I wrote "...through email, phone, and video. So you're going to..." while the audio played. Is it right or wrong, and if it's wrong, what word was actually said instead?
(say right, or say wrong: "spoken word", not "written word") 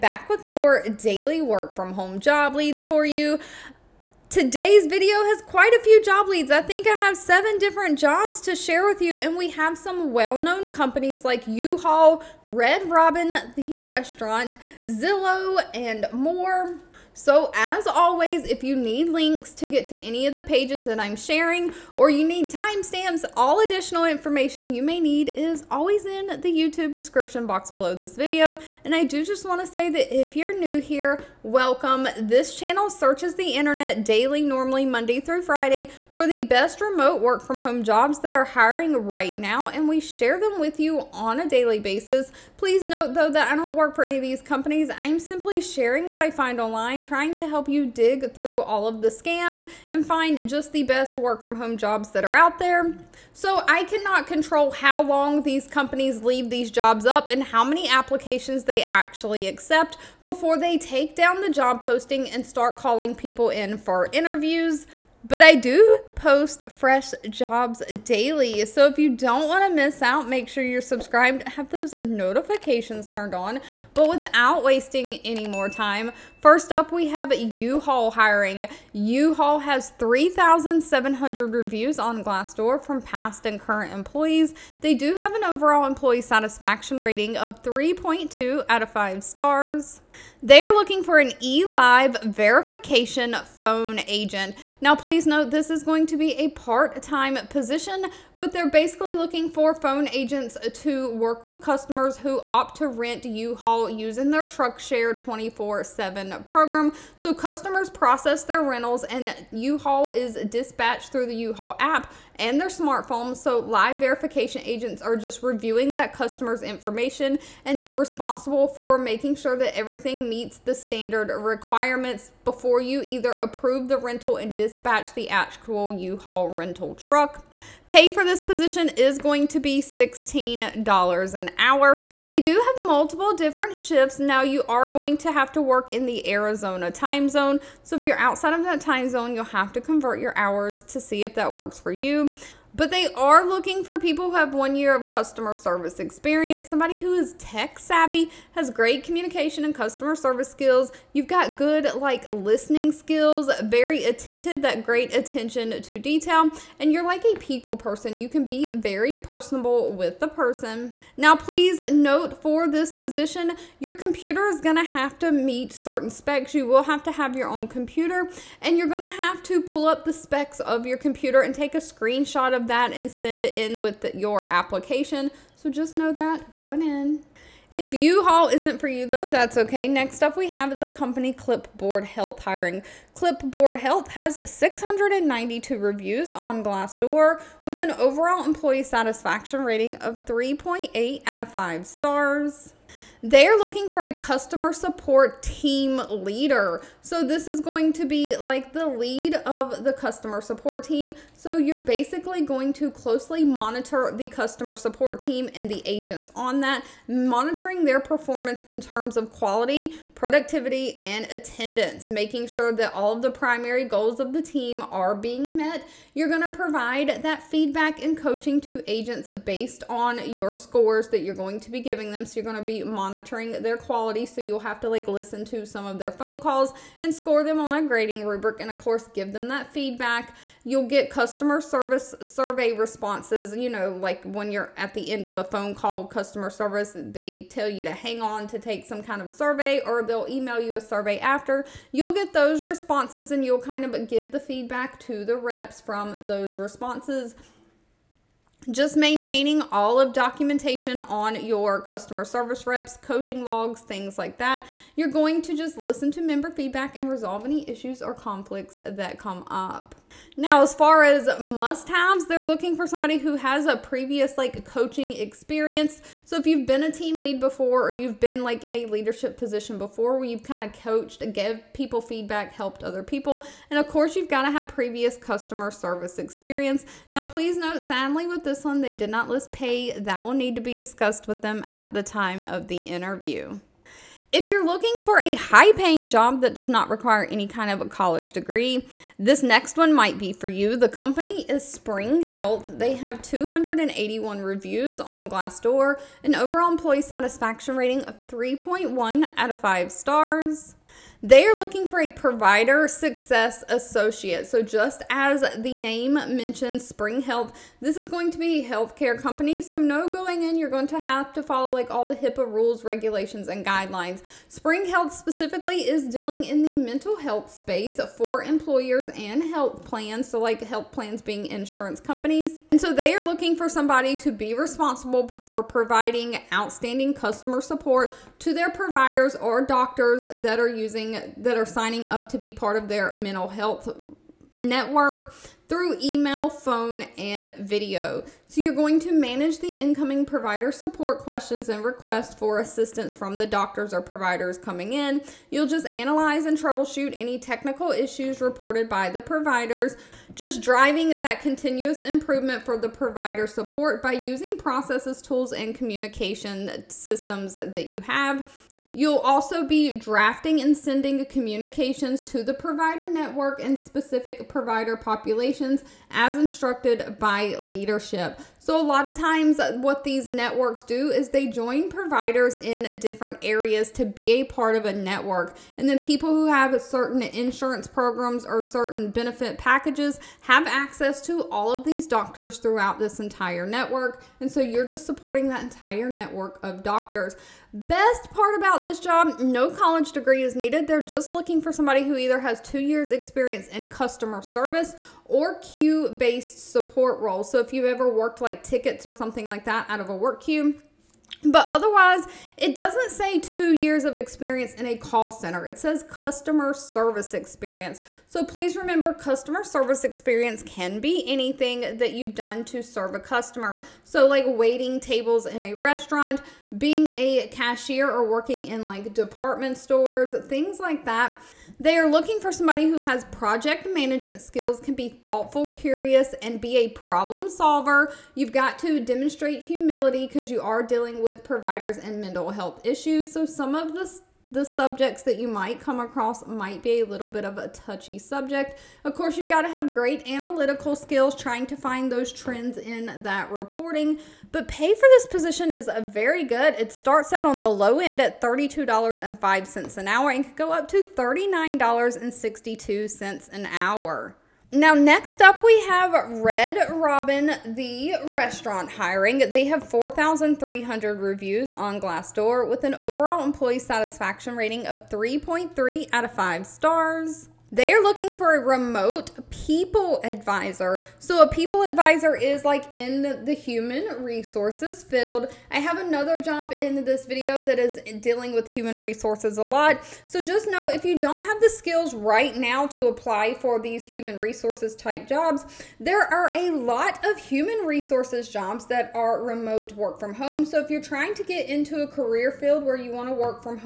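right.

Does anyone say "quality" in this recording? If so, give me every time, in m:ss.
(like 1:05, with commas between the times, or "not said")
3:29, 3:43.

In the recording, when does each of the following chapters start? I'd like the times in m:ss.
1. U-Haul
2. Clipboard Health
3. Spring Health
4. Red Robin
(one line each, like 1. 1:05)
1. 1:16
2. 2:57
3. 4:43
4. 7:34.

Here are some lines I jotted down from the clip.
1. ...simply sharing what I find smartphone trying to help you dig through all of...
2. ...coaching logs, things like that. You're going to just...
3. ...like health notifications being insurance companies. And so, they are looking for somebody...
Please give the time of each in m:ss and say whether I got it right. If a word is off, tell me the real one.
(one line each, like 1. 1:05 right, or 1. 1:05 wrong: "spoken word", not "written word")
1. 0:45 wrong: "online", not "smartphone"
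2. 4:12 right
3. 5:20 wrong: "plans", not "notifications".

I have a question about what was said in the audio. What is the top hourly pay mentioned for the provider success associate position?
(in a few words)
$39.62.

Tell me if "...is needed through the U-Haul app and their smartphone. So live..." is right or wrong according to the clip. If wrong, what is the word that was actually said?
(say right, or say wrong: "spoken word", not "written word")
wrong: "dispatched", not "needed".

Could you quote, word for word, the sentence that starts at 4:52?
They have 281 reviews on Glassdoor, an overall employee satisfaction rating of 3.1 out of 5 stars.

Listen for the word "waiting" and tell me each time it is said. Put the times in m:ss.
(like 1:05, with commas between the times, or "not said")
6:54.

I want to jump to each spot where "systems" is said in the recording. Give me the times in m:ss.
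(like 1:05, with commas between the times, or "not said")
5:56.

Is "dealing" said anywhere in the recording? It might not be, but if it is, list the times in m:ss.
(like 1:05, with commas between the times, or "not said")
5:16, 7:10, 7:58.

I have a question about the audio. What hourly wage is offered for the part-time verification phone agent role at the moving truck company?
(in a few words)
$16 an hour.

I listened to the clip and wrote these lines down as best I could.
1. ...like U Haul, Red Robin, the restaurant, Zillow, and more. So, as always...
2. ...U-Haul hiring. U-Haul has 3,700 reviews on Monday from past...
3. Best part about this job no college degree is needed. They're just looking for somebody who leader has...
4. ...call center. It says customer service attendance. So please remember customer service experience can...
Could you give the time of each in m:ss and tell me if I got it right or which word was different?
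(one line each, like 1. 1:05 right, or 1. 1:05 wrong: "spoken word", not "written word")
1. 0:11 right
2. 1:17 wrong: "Glassdoor", not "Monday"
3. 6:27 wrong: "either", not "leader"
4. 6:44 wrong: "experience", not "attendance".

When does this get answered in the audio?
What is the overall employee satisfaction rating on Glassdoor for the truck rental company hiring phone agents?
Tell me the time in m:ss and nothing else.
1:27.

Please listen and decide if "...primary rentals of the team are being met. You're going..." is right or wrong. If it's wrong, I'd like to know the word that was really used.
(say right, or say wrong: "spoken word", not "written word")
wrong: "goals", not "rentals".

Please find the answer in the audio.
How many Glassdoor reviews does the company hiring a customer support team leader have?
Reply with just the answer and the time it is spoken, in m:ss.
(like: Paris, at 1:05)
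692, at 3:04.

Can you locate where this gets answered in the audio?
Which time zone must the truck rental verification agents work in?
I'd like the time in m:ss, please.
2:16.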